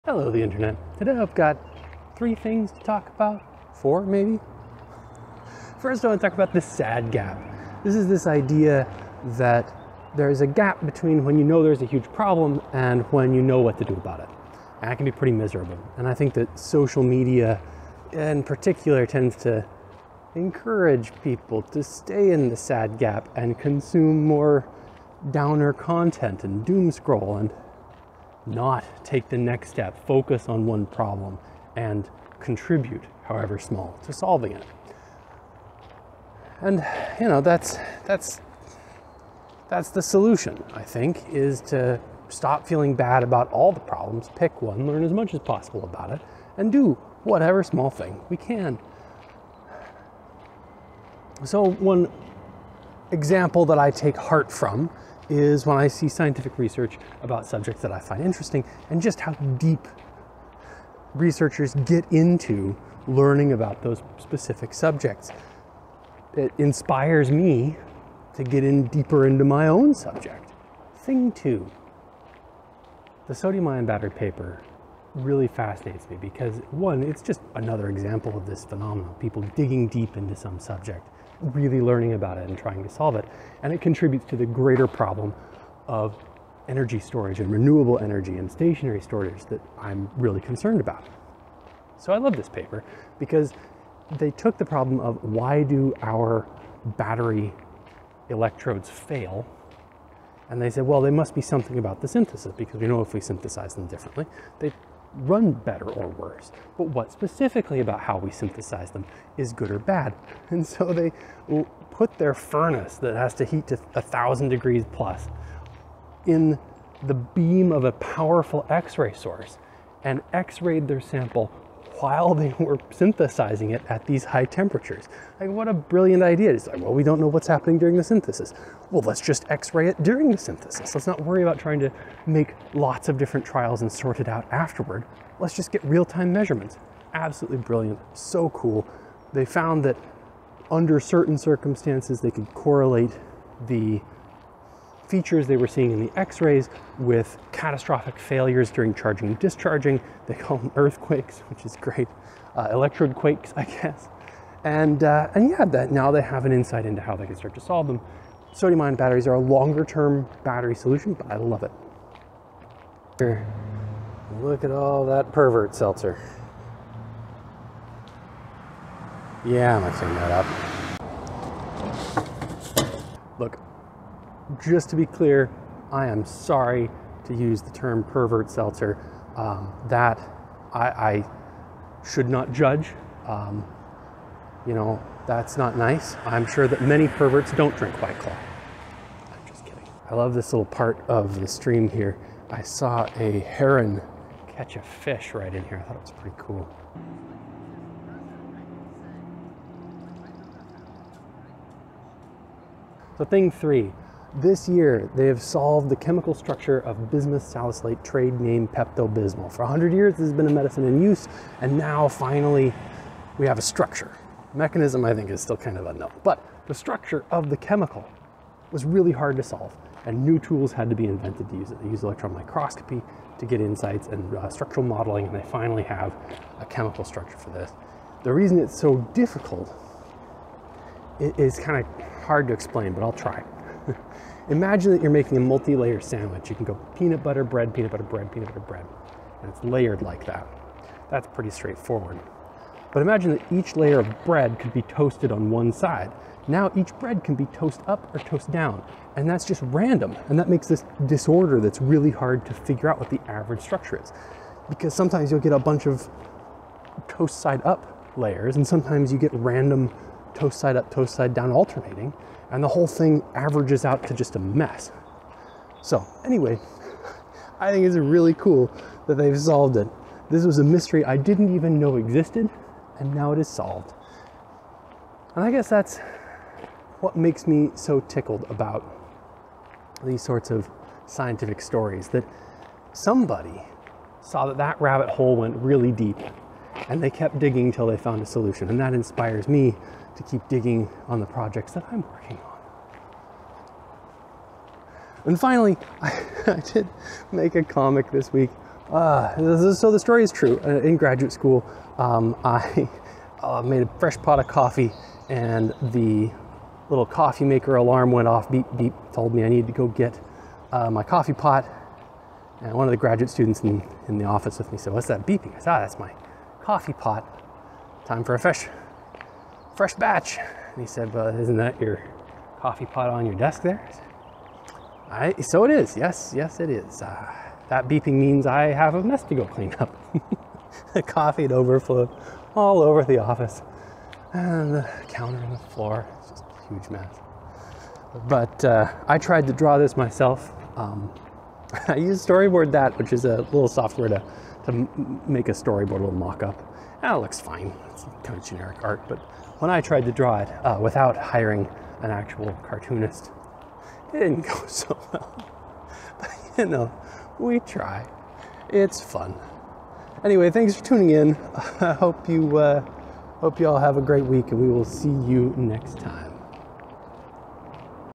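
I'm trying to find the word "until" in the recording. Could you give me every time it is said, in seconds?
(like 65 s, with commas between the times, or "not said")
287 s.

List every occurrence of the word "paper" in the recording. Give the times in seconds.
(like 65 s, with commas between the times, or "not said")
74 s, 92 s.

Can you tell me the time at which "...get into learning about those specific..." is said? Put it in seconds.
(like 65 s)
61 s.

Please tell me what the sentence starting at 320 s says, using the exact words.
And he said, well, isn't that your coffee pot on your desk there?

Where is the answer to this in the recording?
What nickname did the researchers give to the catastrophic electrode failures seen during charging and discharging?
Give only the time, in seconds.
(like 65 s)
150 s.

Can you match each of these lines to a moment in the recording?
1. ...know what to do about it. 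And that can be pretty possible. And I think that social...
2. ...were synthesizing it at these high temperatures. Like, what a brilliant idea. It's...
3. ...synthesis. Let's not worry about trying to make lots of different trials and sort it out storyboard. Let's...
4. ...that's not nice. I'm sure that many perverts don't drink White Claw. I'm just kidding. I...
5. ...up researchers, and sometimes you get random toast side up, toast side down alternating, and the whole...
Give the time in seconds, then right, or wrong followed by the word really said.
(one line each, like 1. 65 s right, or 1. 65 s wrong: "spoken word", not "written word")
1. 13 s wrong: "miserable", not "possible"
2. 122 s right
3. 130 s wrong: "afterward", not "storyboard"
4. 185 s right
5. 257 s wrong: "layers", not "researchers".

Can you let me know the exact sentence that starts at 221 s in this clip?
They used electron microscopy to get insights and uh, structural modeling, and they finally have a chemical structure for this.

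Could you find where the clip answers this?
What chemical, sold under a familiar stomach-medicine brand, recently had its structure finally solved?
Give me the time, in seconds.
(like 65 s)
207 s.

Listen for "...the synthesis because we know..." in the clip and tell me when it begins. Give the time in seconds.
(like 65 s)
102 s.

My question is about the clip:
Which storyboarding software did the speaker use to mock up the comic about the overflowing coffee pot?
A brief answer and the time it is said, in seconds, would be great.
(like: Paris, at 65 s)
Storyboard That, at 342 s.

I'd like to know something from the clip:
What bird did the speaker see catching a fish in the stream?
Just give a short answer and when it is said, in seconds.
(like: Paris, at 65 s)
heron, at 193 s.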